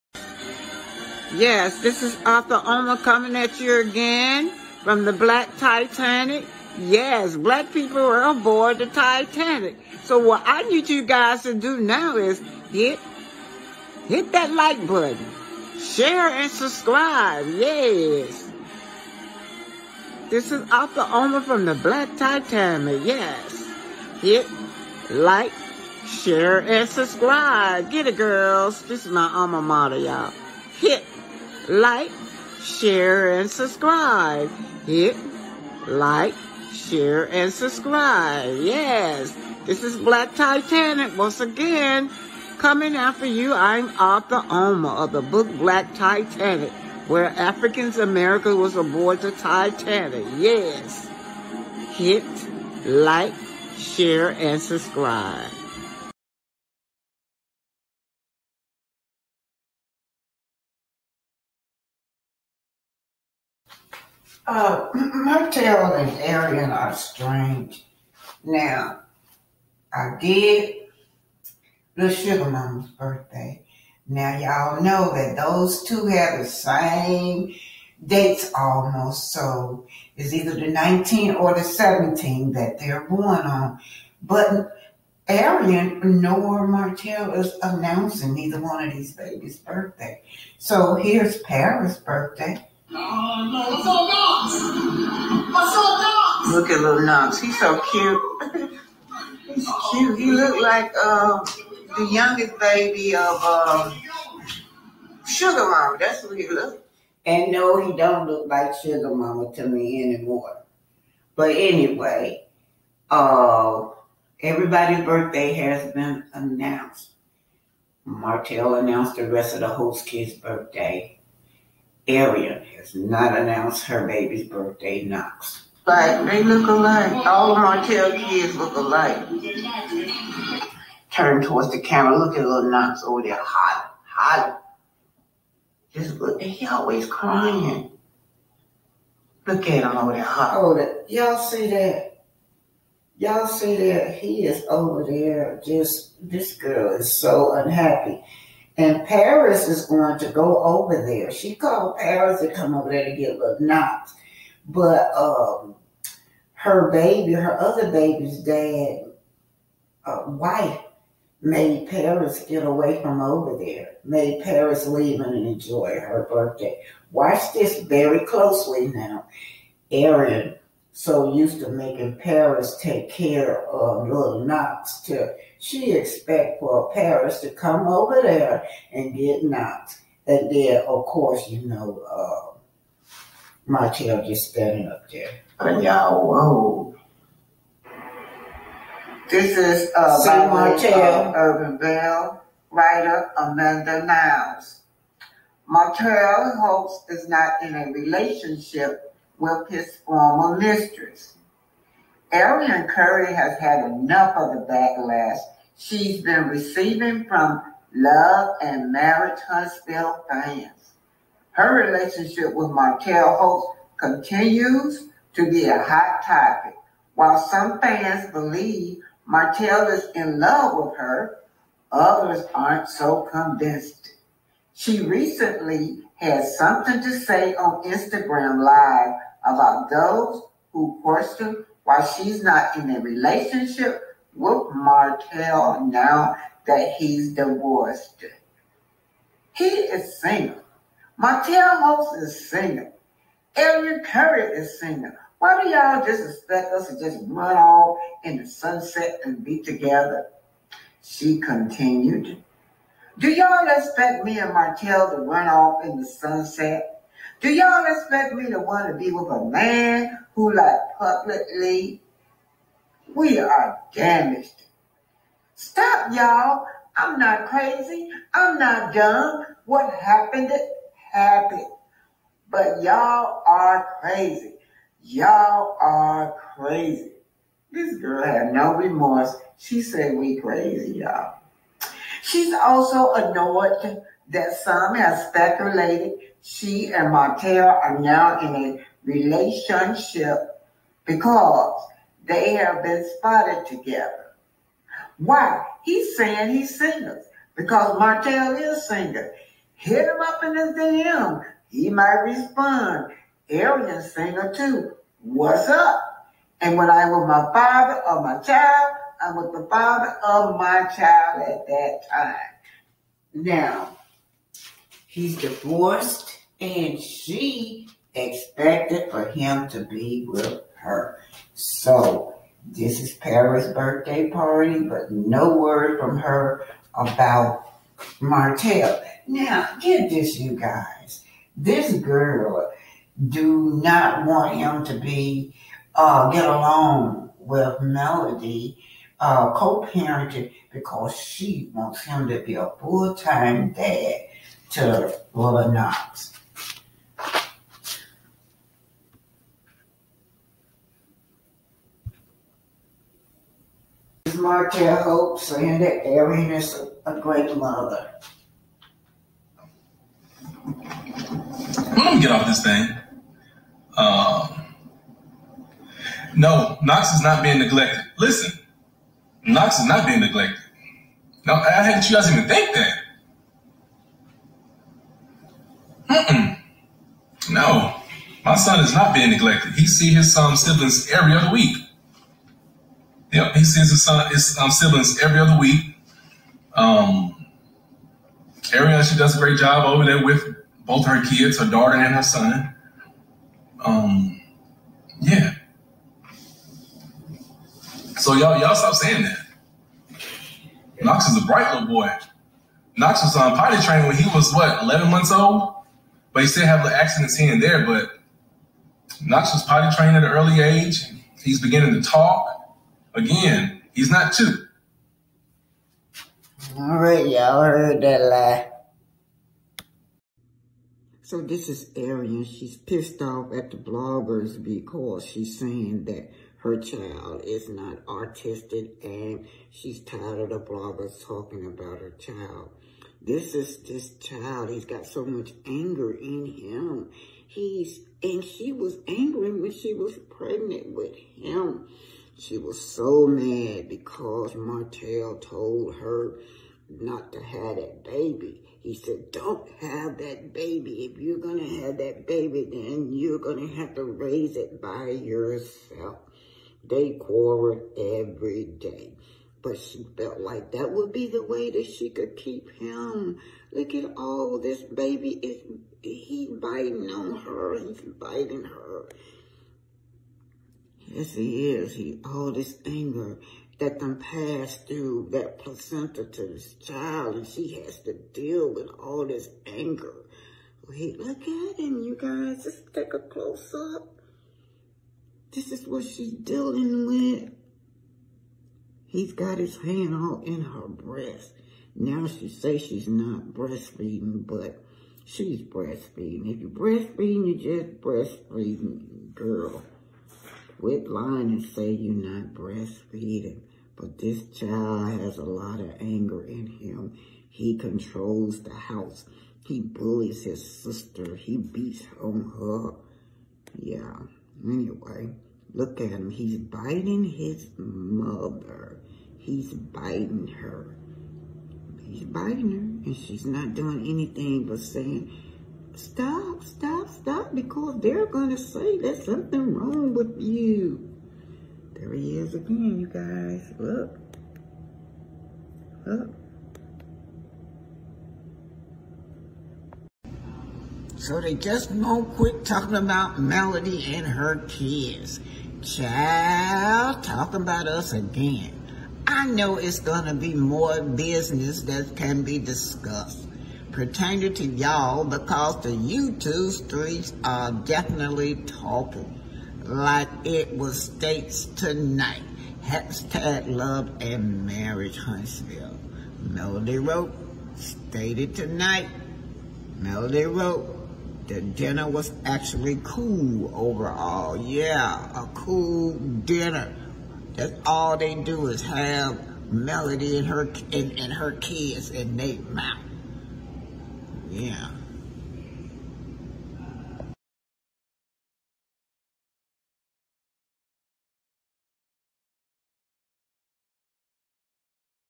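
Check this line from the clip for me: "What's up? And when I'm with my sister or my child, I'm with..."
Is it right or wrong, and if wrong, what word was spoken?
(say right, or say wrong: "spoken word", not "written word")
wrong: "father", not "sister".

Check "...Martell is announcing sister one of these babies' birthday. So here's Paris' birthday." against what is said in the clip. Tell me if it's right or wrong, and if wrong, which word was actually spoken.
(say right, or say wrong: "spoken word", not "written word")
wrong: "neither", not "sister".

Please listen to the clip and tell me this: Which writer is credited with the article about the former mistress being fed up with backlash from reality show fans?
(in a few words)
Amanda Niles.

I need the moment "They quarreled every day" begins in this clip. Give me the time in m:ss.
7:36.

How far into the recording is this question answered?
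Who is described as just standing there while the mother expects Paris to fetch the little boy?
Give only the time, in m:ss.
3:03.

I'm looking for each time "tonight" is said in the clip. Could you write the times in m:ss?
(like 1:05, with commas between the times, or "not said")
9:21, 9:28.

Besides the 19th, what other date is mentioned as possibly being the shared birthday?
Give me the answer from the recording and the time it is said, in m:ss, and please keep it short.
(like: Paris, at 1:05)
17, at 1:21.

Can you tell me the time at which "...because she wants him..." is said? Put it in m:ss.
5:40.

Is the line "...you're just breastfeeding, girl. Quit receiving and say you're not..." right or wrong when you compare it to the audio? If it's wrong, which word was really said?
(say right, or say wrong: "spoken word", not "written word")
wrong: "lying", not "receiving".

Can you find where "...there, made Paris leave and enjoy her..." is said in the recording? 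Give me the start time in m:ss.
2:43.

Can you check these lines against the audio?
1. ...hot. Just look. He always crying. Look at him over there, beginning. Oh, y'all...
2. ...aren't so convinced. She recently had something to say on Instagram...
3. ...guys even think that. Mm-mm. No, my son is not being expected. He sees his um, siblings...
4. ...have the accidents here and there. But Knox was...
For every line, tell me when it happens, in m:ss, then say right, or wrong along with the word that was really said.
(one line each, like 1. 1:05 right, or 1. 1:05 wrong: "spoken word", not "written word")
1. 2:14 wrong: "hollering", not "beginning"
2. 3:42 right
3. 6:12 wrong: "neglected", not "expected"
4. 6:46 right.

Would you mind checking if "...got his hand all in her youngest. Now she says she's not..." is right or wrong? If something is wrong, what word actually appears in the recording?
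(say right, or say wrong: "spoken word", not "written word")
wrong: "breast", not "youngest".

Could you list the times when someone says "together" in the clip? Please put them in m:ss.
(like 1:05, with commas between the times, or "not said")
4:09, 4:53.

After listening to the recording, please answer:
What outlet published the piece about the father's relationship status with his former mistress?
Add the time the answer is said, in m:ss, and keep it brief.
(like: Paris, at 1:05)
Urban Belle, at 3:11.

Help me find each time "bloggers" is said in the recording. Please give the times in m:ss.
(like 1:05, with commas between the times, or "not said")
7:03, 7:10.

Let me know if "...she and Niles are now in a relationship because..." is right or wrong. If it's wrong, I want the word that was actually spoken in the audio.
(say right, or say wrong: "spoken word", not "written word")
wrong: "Martell", not "Niles".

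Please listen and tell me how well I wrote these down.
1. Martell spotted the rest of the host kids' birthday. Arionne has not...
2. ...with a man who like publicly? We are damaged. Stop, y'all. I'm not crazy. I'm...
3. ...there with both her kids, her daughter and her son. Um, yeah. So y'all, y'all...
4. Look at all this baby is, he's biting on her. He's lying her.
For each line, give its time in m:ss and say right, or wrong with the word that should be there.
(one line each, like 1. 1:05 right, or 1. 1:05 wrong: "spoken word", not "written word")
1. 1:58 wrong: "announced", not "spotted"
2. 4:19 right
3. 6:30 right
4. 7:43 wrong: "biting", not "lying".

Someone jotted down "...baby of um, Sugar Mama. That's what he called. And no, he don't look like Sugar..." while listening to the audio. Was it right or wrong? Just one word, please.
wrong.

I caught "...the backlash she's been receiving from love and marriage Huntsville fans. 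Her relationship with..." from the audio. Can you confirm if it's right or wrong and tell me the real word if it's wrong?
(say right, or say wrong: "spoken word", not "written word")
right.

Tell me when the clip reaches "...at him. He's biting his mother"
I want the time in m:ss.
8:36.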